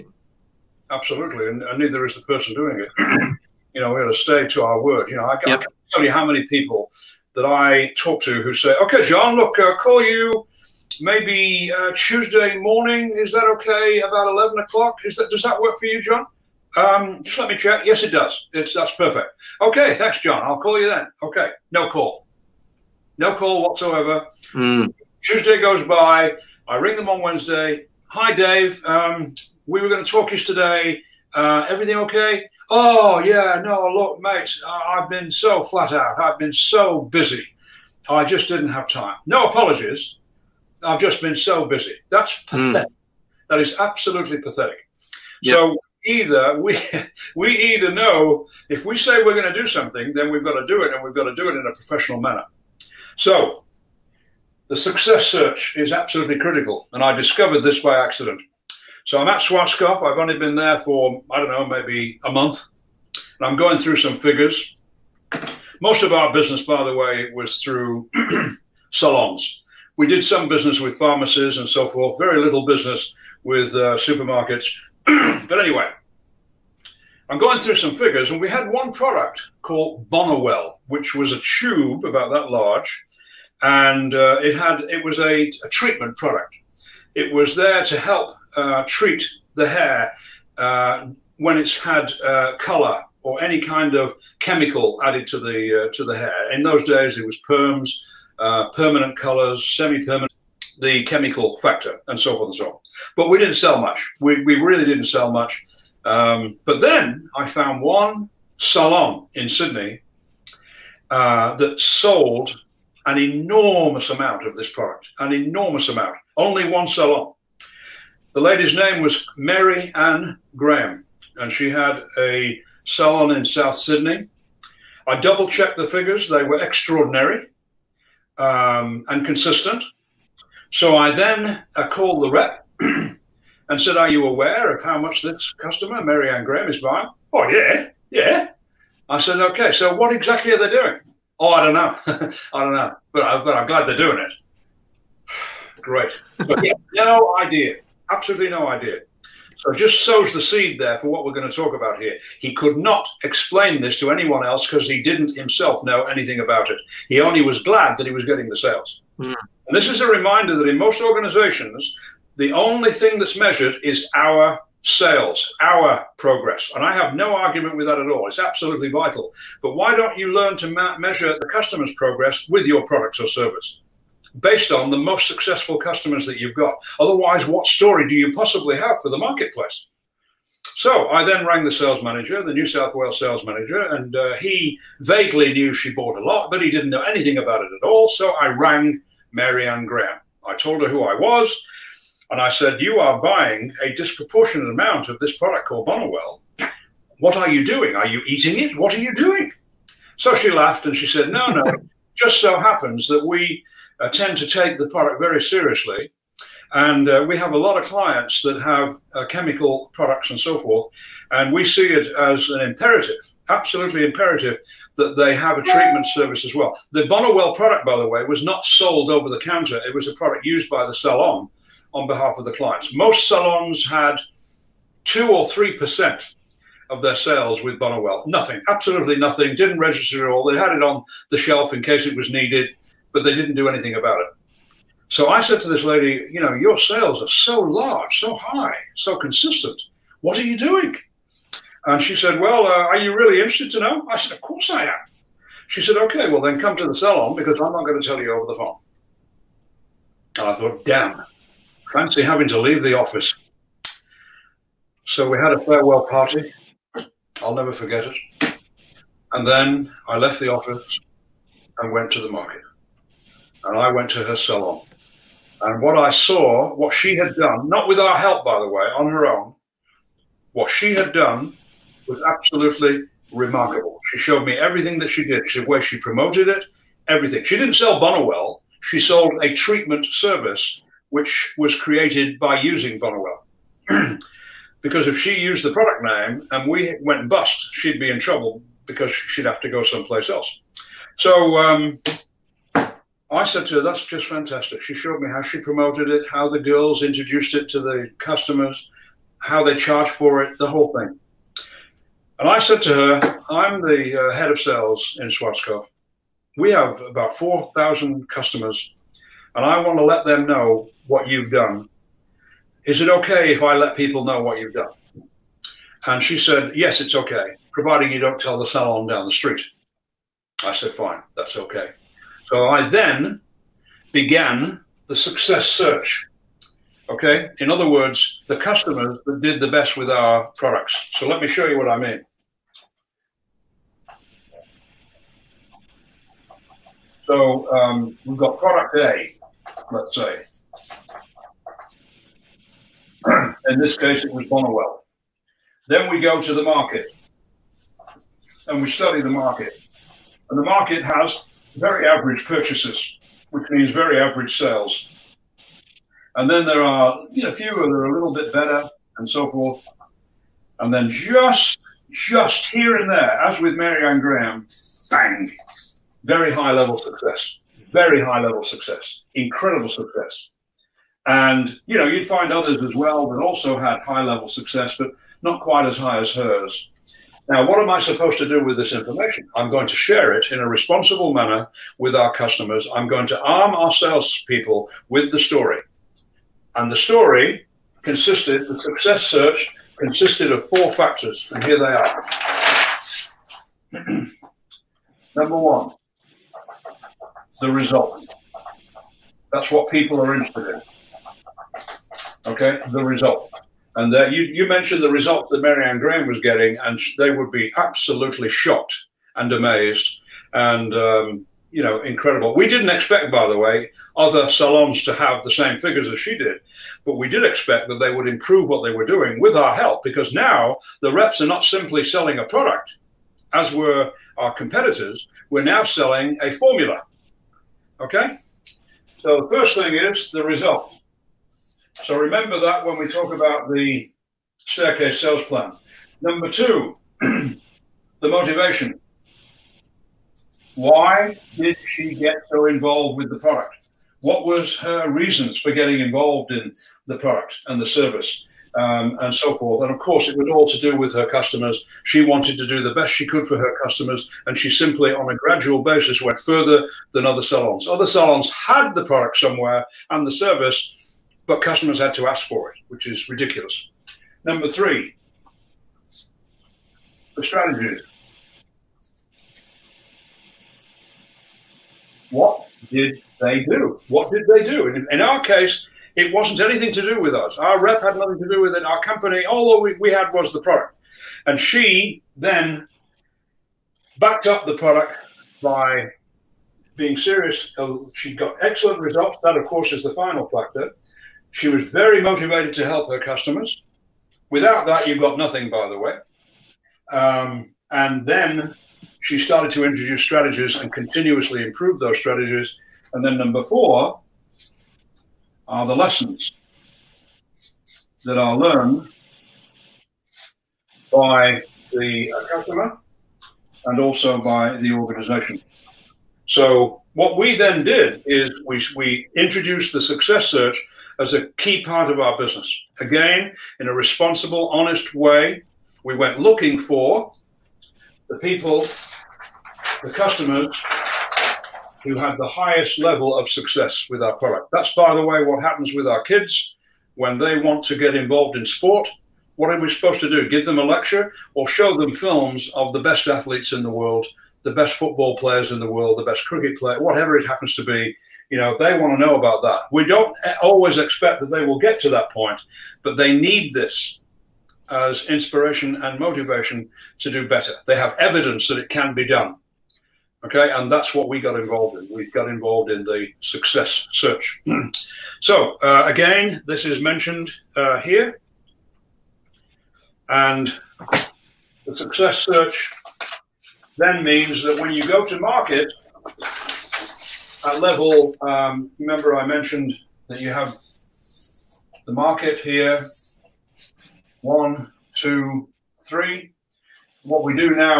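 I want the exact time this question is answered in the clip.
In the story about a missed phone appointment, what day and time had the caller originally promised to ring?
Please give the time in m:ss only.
0:11.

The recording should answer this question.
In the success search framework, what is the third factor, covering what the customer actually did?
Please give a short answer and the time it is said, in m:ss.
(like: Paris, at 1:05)
The strategies, at 7:47.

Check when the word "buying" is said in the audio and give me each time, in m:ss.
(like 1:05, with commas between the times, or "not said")
2:16, 3:13.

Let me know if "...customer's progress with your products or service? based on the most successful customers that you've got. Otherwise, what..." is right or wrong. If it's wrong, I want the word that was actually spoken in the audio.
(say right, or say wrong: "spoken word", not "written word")
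right.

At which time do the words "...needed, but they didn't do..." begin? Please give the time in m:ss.
3:52.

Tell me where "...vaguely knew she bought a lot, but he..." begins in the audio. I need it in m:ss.
3:05.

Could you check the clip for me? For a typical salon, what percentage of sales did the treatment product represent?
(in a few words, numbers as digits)
2 or 3 percent.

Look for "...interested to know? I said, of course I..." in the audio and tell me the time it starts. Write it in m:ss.
4:03.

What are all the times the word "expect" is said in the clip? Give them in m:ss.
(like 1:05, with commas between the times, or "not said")
6:52, 6:57, 9:10.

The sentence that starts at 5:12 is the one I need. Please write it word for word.
Is it okay if I let people know what you've done?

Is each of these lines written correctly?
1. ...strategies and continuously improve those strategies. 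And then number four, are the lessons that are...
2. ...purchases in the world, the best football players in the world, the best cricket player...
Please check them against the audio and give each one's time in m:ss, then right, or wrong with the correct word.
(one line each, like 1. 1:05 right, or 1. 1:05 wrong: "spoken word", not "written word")
1. 8:20 right
2. 9:03 wrong: "athletes", not "purchases".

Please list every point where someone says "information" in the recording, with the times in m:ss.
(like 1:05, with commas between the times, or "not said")
6:18.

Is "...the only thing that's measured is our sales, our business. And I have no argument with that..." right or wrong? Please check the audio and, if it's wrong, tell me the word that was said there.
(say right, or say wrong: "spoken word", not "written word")
wrong: "progress", not "business".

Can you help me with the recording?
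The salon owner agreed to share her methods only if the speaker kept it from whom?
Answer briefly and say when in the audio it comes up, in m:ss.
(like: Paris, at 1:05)
The salon down the street, at 5:18.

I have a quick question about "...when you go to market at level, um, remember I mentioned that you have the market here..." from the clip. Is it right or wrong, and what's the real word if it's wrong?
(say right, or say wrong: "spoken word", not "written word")
right.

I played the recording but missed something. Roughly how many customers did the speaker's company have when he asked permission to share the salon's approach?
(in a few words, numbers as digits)
4,000.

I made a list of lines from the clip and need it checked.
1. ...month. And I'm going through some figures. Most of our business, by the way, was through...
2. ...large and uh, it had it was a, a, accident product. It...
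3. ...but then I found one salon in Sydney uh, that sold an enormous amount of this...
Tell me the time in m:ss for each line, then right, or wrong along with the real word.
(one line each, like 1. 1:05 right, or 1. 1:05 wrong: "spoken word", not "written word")
1. 1:02 right
2. 1:22 wrong: "treatment", not "accident"
3. 1:46 right.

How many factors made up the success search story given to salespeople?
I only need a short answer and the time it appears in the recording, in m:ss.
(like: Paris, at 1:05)
4, at 6:30.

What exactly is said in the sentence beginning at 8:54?
That's, by the way, what happens with our kids when they want to get involved in sport.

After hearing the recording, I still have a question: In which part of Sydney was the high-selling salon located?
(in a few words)
South Sydney.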